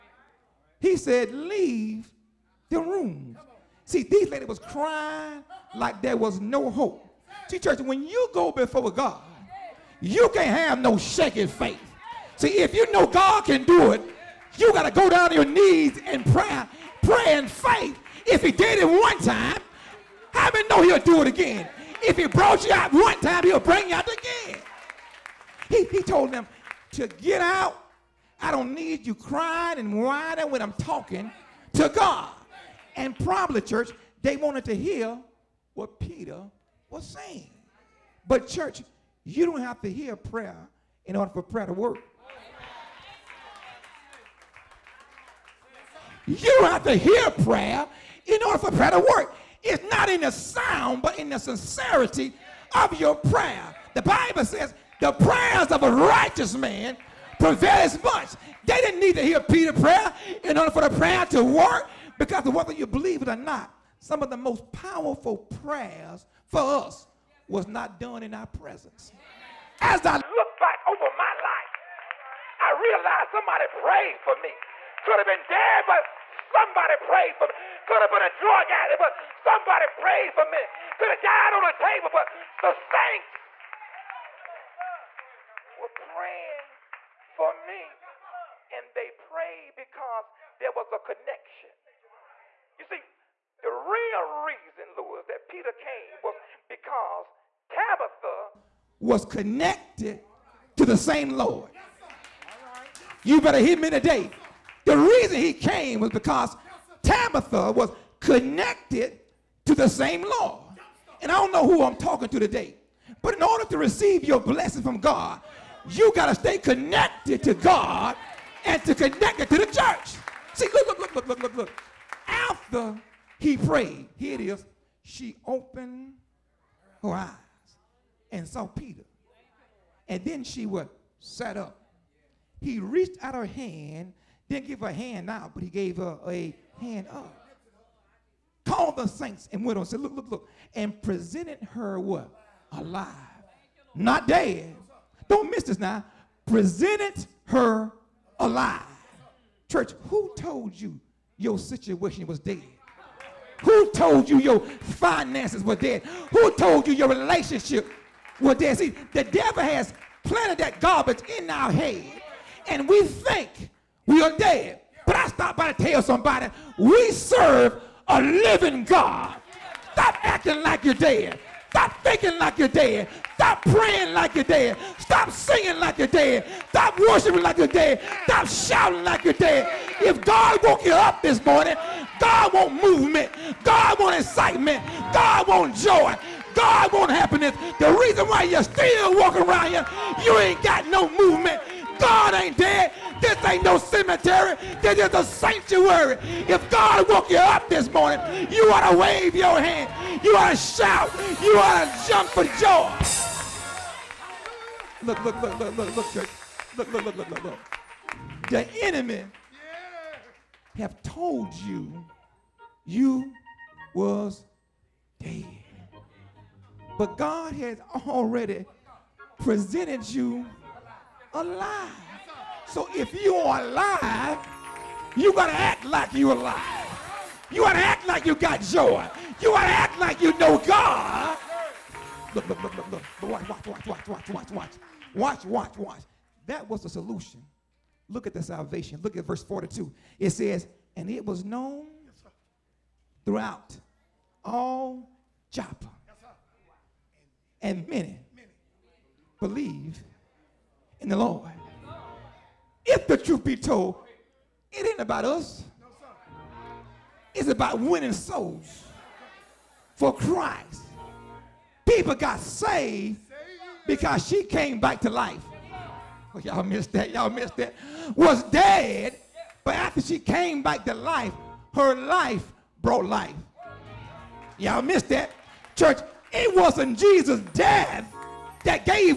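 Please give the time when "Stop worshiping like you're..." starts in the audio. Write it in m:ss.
2:56.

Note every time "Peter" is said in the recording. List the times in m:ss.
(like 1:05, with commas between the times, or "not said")
0:35, 0:59, 1:35, 2:08.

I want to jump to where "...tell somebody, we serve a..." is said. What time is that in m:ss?
2:45.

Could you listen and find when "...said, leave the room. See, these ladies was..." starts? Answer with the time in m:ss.
0:00.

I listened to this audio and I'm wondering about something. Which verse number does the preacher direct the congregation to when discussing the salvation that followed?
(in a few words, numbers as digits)
42.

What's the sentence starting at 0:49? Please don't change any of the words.
It's not in the sound, but in the sincerity of your prayer.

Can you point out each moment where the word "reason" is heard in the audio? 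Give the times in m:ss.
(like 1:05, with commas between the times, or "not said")
1:34, 1:44, 3:07.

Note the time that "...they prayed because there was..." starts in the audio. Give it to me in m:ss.
1:28.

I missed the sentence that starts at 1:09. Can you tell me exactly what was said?
As I look back over my life, I realize somebody prayed for me.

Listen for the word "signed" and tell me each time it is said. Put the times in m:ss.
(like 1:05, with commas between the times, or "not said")
not said.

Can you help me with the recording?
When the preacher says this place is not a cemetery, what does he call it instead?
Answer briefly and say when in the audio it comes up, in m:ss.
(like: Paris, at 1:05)
A sanctuary, at 3:15.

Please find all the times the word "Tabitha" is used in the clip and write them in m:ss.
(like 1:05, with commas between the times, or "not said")
1:37, 1:47.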